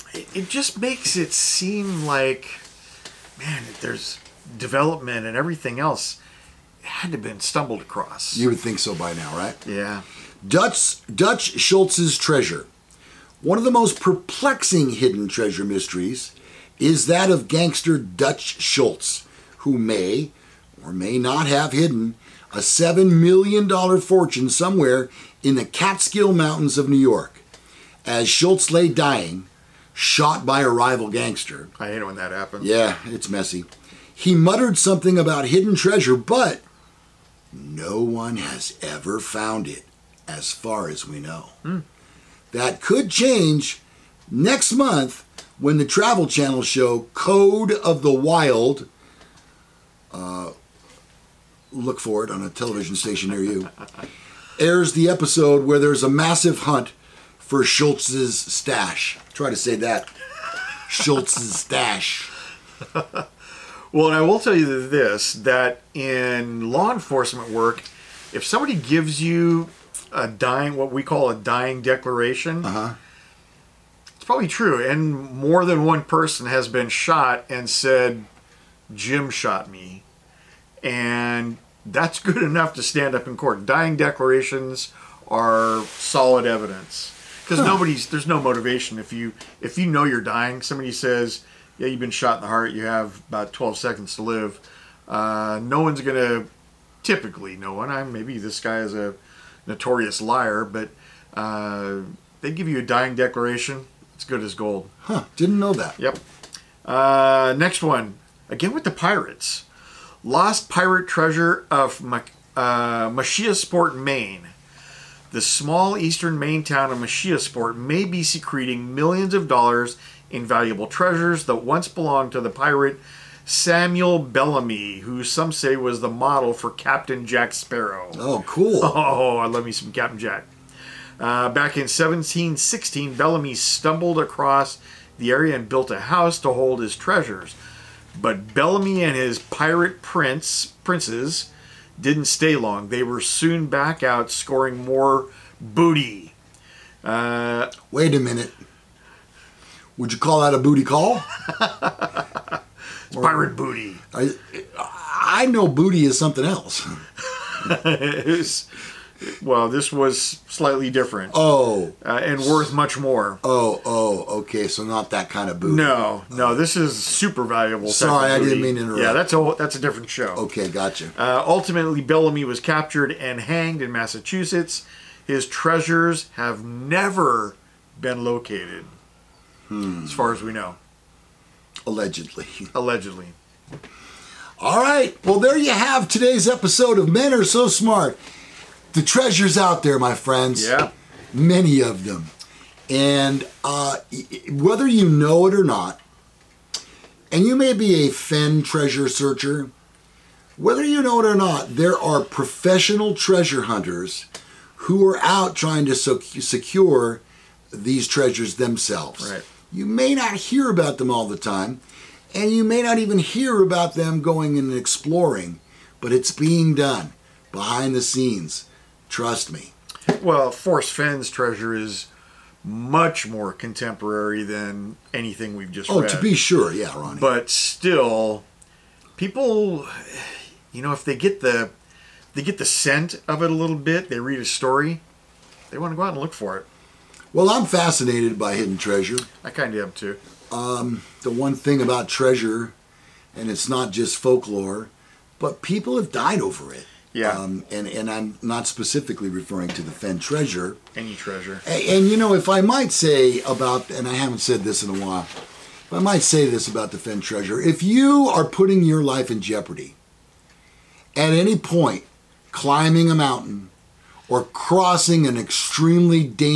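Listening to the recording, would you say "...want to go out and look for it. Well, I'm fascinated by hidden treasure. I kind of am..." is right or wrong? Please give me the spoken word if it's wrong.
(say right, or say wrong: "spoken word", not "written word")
right.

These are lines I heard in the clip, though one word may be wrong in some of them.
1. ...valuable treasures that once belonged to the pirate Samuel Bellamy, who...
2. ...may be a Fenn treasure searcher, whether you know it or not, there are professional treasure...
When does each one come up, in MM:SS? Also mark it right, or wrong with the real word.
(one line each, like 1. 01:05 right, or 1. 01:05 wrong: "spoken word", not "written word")
1. 02:00 right
2. 03:17 right.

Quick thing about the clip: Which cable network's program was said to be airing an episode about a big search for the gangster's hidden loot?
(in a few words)
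Travel Channel.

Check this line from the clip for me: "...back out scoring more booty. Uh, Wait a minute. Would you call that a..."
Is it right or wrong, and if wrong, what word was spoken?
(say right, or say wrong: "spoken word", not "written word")
right.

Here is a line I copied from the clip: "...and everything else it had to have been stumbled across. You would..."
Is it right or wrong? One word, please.
right.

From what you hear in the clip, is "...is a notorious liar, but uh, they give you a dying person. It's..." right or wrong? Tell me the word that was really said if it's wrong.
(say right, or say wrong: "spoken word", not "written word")
wrong: "declaration", not "person".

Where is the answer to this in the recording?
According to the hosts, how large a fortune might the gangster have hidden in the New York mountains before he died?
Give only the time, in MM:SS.
00:22.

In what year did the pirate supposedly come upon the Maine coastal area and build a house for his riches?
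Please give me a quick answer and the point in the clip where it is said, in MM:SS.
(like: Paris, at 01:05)
1716, at 02:11.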